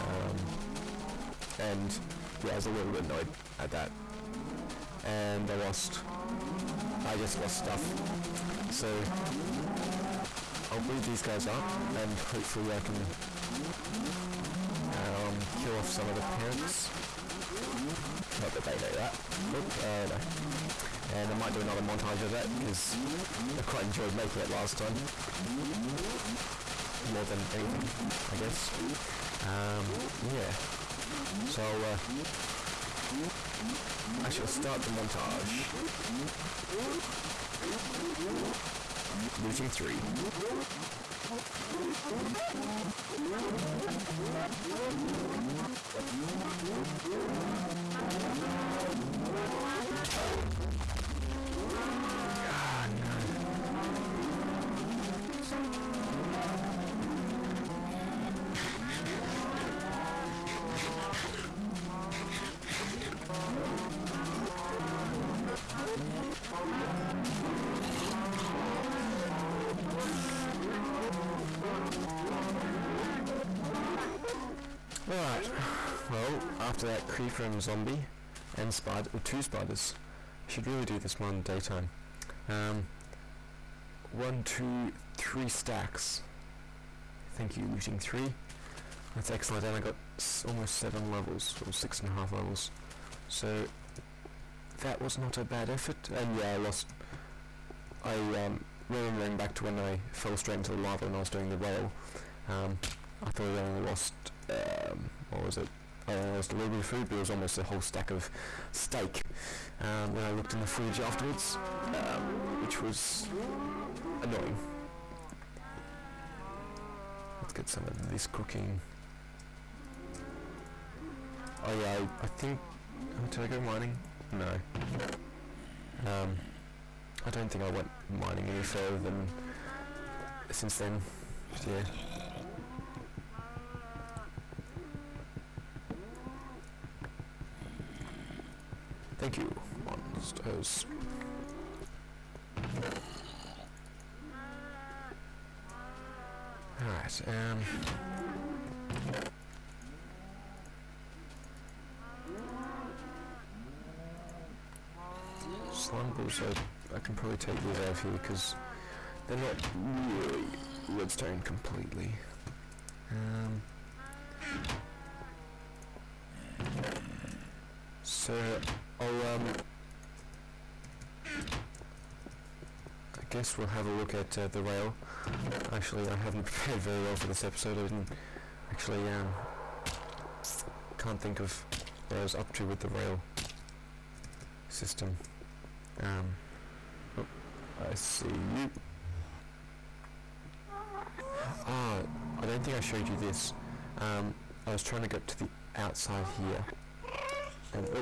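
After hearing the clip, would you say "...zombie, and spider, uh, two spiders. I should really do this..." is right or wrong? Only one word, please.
right.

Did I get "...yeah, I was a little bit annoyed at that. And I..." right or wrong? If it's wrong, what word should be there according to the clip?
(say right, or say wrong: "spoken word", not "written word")
right.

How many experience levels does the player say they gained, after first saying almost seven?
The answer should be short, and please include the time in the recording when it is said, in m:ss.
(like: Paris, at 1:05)
6 and a half, at 1:31.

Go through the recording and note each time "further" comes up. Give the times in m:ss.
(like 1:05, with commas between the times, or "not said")
2:08.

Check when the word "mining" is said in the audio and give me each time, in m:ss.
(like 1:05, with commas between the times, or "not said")
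2:03, 2:08.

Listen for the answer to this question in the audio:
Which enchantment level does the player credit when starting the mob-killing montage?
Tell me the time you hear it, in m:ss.
0:39.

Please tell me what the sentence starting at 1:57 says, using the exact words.
Let's get some of this cooking.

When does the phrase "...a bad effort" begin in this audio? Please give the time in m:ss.
1:35.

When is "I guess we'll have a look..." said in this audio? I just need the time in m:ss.
2:51.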